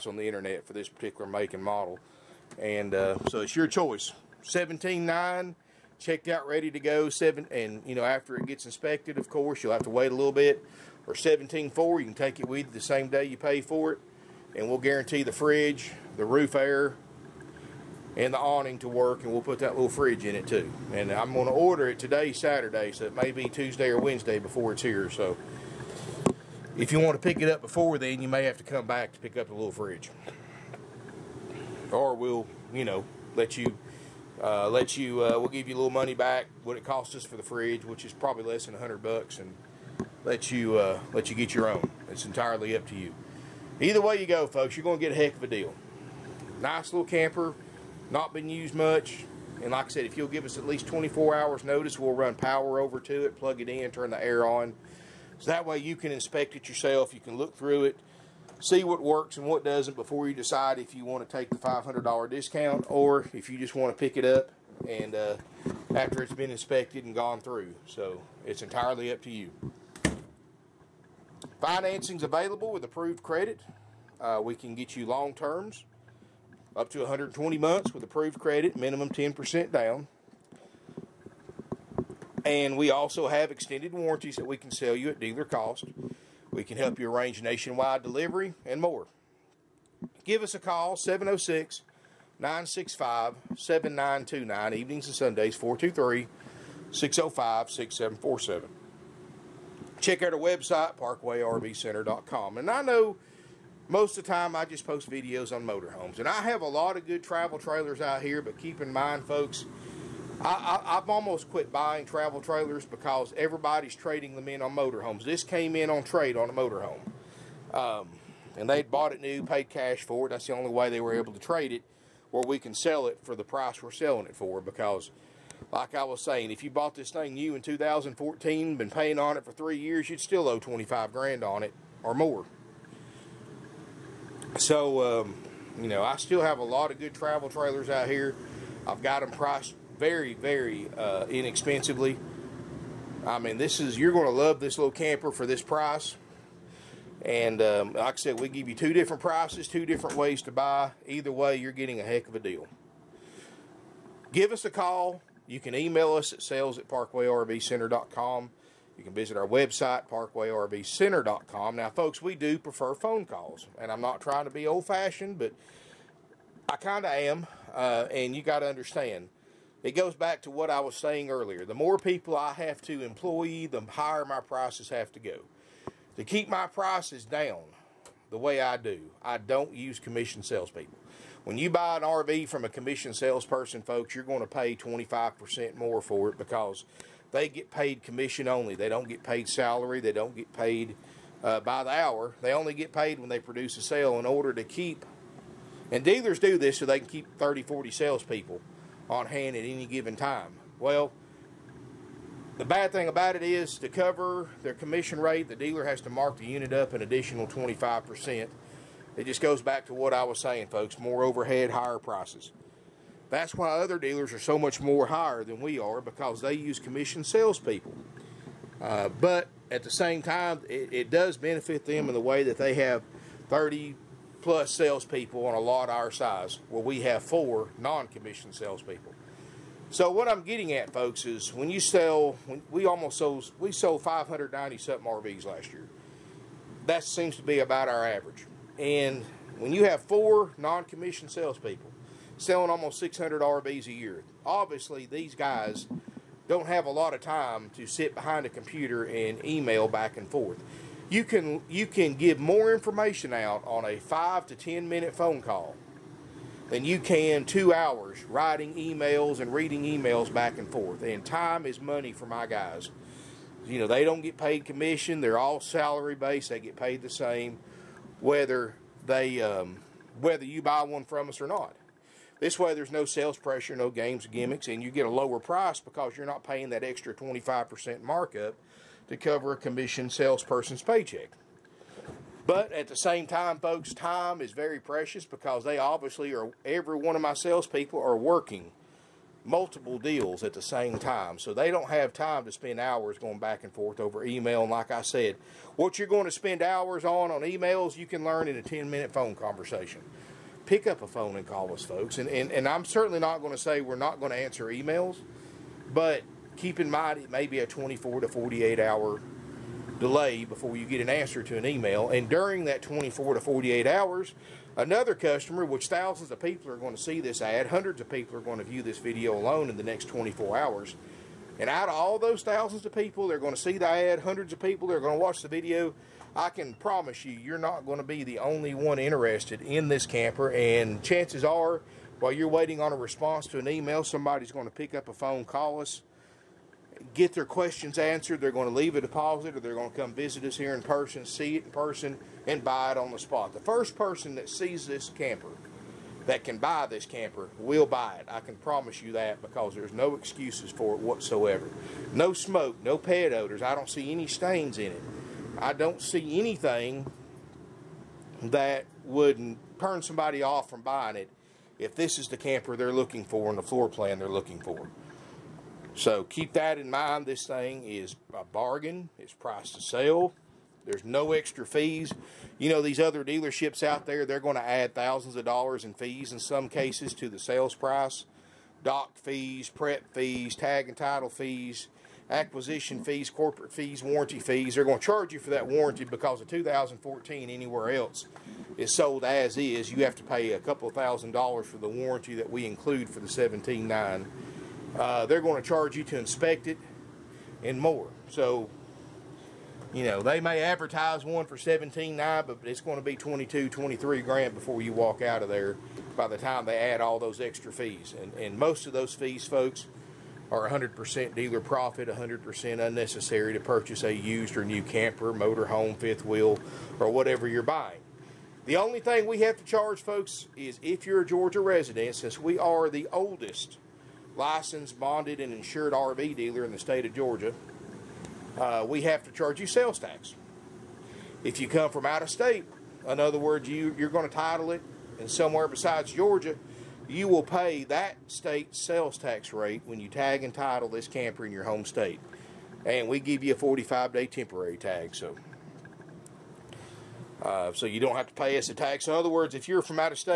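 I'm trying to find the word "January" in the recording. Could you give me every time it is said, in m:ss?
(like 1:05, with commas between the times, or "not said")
not said.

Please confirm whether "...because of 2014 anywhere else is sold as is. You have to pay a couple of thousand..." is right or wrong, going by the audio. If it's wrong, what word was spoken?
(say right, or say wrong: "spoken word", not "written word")
right.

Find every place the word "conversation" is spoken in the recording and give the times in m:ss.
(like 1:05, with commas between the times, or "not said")
4:59.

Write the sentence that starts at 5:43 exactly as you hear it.
The first person that sees this camper, that can buy this camper, will buy it.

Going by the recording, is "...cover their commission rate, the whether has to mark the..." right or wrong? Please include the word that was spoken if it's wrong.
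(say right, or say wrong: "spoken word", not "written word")
wrong: "dealer", not "whether".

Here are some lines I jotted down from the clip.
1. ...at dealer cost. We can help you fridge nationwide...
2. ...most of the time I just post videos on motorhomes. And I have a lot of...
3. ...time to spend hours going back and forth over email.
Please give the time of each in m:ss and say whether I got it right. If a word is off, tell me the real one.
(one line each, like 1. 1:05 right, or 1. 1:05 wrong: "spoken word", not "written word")
1. 1:25 wrong: "arrange", not "fridge"
2. 1:43 right
3. 4:52 right.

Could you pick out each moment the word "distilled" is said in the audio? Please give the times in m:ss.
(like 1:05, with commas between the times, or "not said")
not said.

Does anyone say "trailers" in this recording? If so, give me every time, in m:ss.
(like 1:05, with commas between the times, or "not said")
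1:47, 1:52, 2:17.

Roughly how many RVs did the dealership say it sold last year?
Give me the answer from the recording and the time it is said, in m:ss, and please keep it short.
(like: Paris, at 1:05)
590 something, at 3:54.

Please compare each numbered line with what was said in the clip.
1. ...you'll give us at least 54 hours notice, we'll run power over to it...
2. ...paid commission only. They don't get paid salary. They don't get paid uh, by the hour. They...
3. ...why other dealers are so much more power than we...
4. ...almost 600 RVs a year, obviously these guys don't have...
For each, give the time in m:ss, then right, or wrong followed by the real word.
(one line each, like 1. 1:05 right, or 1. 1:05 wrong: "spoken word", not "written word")
1. 0:50 wrong: "24", not "54"
2. 3:07 right
3. 3:33 wrong: "higher", not "power"
4. 4:02 right.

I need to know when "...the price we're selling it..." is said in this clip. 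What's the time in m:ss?
2:03.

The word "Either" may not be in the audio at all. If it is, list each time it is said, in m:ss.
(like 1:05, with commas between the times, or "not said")
0:43, 2:31.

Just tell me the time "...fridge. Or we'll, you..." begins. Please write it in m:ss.
0:29.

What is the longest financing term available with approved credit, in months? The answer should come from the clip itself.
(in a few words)
120 months.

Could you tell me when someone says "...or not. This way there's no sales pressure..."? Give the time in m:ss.
4:31.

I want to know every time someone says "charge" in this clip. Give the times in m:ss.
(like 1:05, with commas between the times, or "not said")
6:25, 6:35, 6:59, 7:09.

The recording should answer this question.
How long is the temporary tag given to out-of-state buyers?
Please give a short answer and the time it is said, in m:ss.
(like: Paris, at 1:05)
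45 day, at 7:23.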